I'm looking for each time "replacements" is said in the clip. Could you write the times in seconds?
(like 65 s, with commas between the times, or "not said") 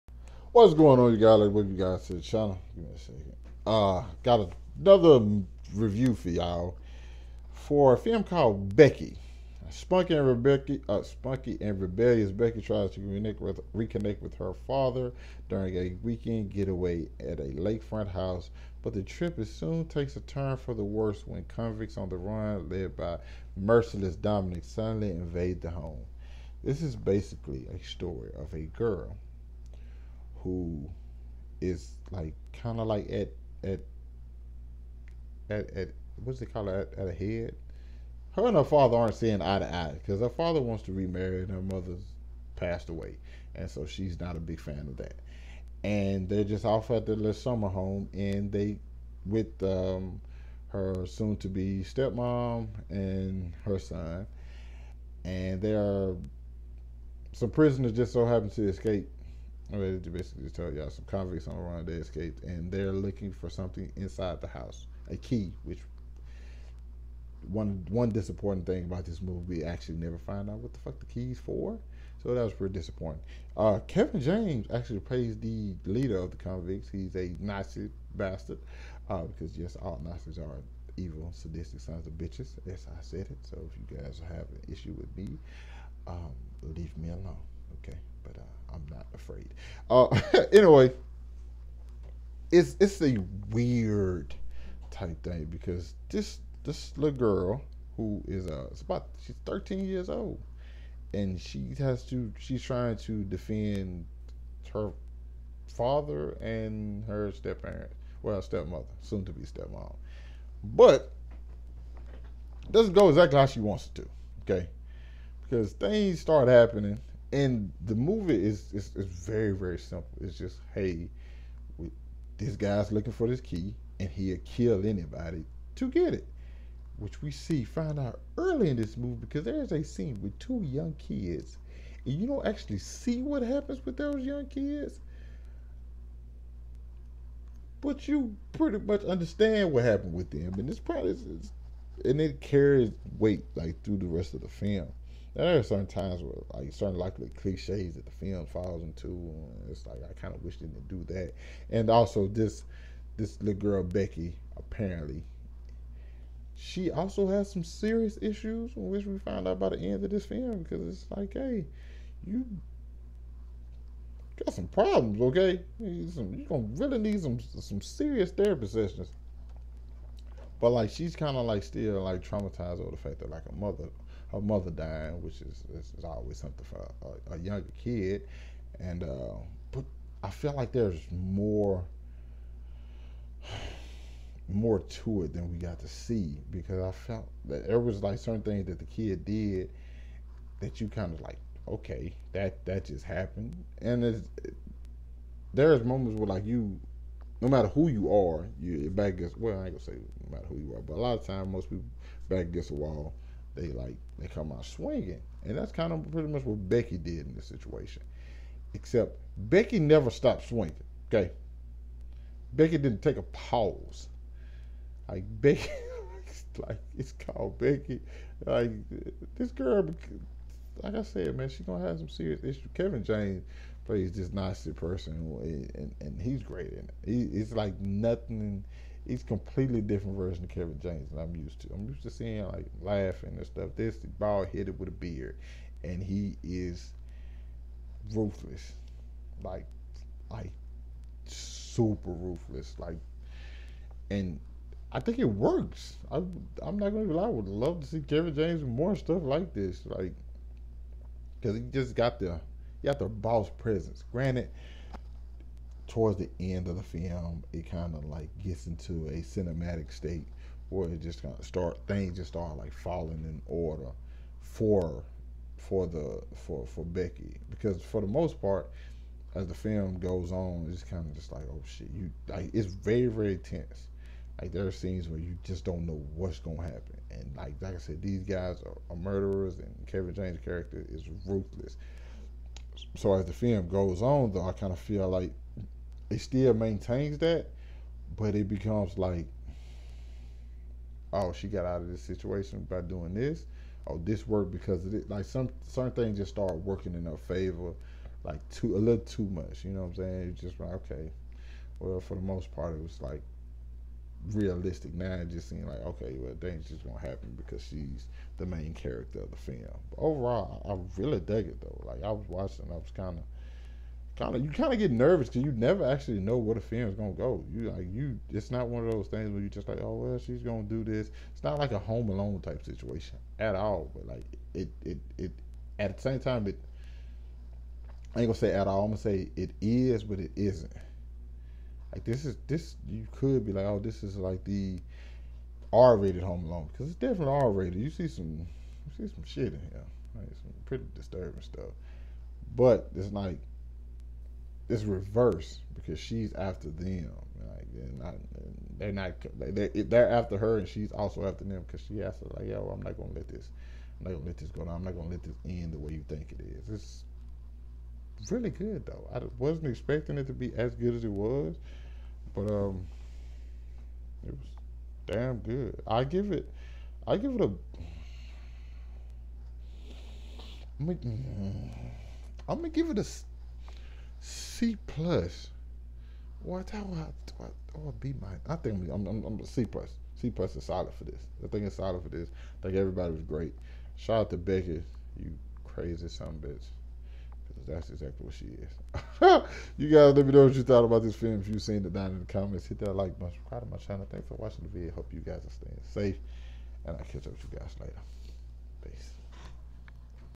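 not said.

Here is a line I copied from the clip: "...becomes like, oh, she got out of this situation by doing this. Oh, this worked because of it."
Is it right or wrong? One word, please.
right.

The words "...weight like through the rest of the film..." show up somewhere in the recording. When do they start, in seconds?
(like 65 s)
143 s.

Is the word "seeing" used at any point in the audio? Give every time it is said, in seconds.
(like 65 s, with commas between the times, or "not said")
39 s, 232 s.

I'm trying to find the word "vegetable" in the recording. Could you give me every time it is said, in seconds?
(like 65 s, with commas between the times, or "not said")
not said.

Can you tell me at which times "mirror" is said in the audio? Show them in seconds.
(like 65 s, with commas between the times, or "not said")
not said.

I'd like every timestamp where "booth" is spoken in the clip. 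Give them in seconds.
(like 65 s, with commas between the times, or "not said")
not said.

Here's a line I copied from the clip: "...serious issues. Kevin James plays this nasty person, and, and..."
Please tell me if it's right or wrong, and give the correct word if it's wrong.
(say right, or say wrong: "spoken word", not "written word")
right.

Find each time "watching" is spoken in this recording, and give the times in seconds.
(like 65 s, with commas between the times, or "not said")
312 s, 394 s.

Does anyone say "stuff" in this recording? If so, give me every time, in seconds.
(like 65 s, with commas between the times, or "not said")
233 s, 248 s, 341 s.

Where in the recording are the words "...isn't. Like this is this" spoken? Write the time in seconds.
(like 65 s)
330 s.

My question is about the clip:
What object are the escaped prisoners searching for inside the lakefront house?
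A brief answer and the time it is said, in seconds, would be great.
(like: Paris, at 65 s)
A key, at 65 s.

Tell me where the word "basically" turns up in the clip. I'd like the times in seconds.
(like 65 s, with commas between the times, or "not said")
26 s, 60 s.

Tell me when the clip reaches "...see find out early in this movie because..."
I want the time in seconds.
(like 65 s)
127 s.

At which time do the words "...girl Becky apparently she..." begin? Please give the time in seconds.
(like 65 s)
153 s.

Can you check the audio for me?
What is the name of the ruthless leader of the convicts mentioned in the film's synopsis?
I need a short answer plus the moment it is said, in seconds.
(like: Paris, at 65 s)
Dominick, at 24 s.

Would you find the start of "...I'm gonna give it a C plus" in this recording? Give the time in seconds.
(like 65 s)
372 s.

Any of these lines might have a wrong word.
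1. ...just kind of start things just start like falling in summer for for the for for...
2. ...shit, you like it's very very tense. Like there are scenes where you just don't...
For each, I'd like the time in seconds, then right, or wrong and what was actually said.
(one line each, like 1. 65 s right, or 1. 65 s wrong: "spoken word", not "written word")
1. 261 s wrong: "order", not "summer"
2. 271 s right.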